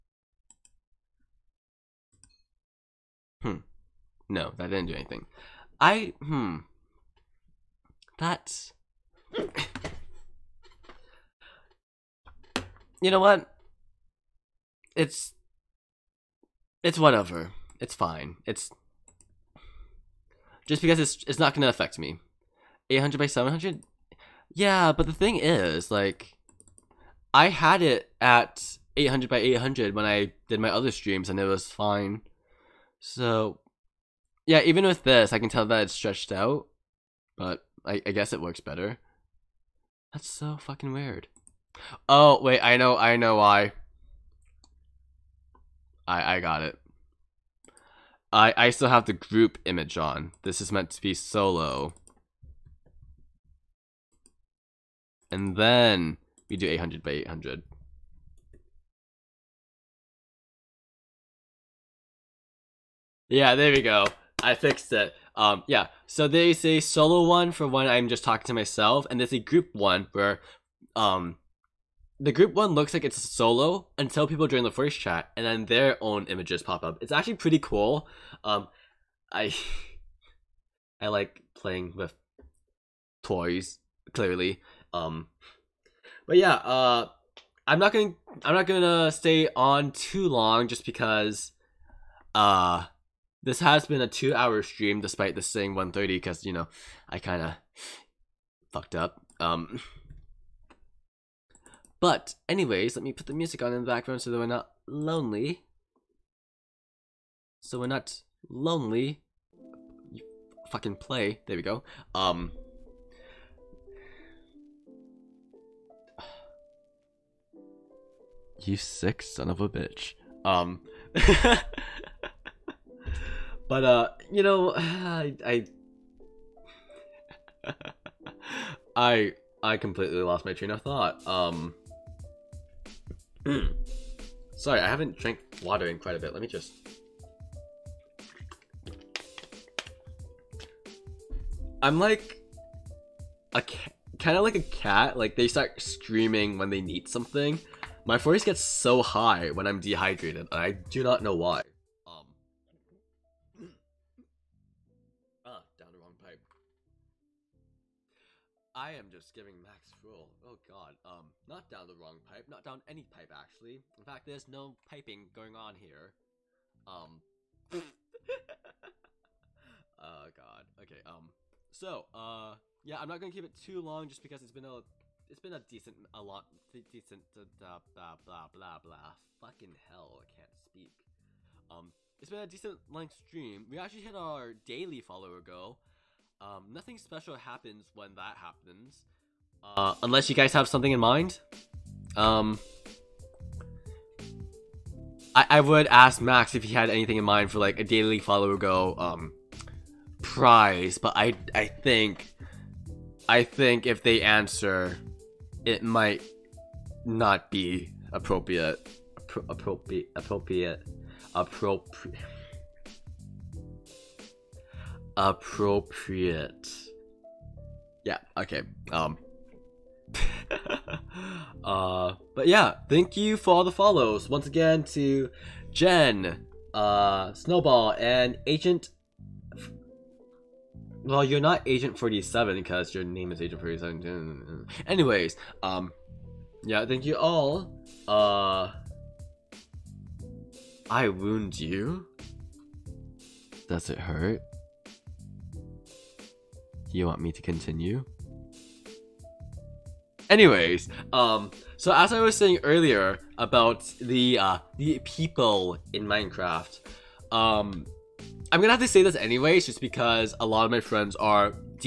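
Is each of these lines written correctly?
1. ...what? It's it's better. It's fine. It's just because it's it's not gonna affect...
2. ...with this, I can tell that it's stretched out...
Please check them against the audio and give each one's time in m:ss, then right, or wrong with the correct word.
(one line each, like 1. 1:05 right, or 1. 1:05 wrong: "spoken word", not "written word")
1. 0:13 wrong: "whatever", not "better"
2. 0:34 right.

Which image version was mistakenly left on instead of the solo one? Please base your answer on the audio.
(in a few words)
group image.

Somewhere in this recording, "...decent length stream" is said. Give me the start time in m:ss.
3:02.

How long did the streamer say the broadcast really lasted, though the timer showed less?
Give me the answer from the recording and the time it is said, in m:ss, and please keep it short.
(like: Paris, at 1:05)
2 hours, at 1:34.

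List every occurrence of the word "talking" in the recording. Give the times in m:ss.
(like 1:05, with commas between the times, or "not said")
1:08.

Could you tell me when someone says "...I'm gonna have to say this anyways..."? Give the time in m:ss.
4:18.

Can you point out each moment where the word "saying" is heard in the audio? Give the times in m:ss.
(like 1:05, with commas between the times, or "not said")
1:35, 4:12.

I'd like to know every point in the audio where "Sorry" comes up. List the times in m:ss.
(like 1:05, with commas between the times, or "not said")
2:14.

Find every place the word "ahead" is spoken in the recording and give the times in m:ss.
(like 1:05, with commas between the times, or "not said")
not said.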